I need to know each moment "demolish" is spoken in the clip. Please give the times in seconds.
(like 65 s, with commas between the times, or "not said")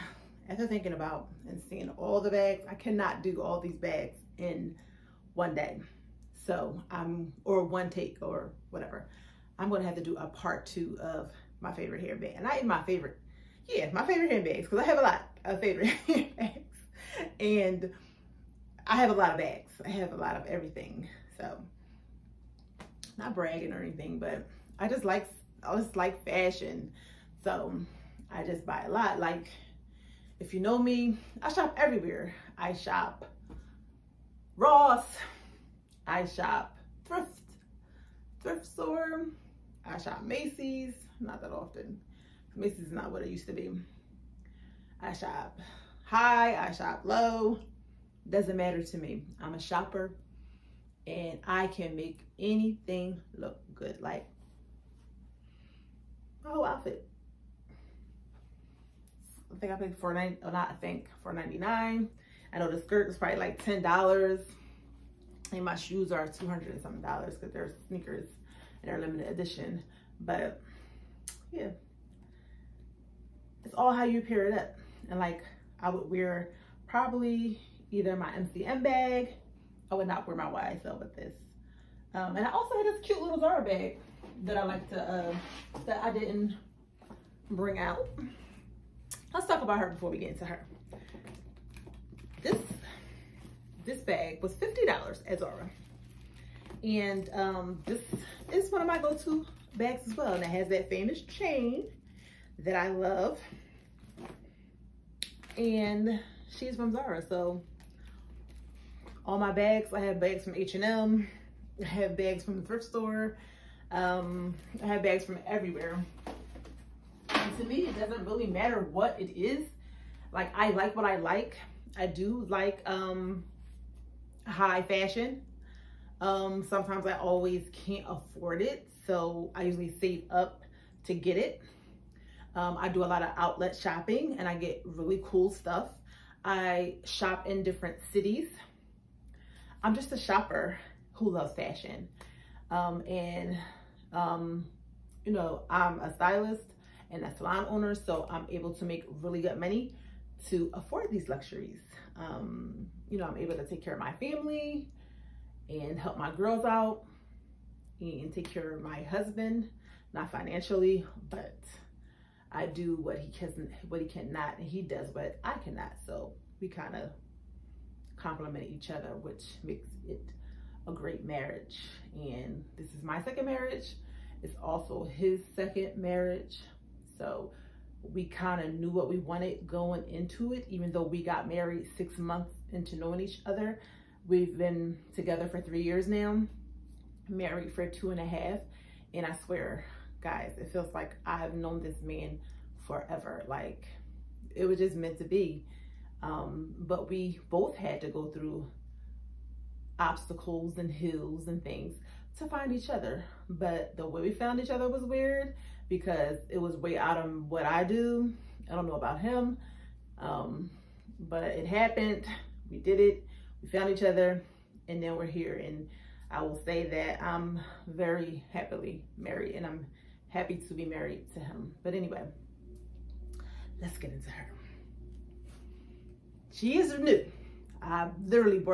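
not said.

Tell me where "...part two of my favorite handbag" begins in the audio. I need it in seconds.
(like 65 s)
10 s.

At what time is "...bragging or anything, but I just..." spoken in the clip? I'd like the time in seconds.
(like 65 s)
23 s.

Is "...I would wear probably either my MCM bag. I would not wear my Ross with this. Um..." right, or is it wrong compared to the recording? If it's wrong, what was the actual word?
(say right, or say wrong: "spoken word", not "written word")
wrong: "YSL", not "Ross".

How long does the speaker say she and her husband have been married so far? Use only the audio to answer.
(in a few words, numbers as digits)
2 and a half years.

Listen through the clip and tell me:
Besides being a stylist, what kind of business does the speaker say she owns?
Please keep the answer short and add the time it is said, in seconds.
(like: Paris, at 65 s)
salon, at 147 s.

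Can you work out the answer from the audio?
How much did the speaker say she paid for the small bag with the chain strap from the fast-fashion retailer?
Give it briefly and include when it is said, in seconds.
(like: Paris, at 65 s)
$50, at 94 s.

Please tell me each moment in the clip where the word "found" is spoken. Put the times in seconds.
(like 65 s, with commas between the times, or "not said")
204 s, 213 s.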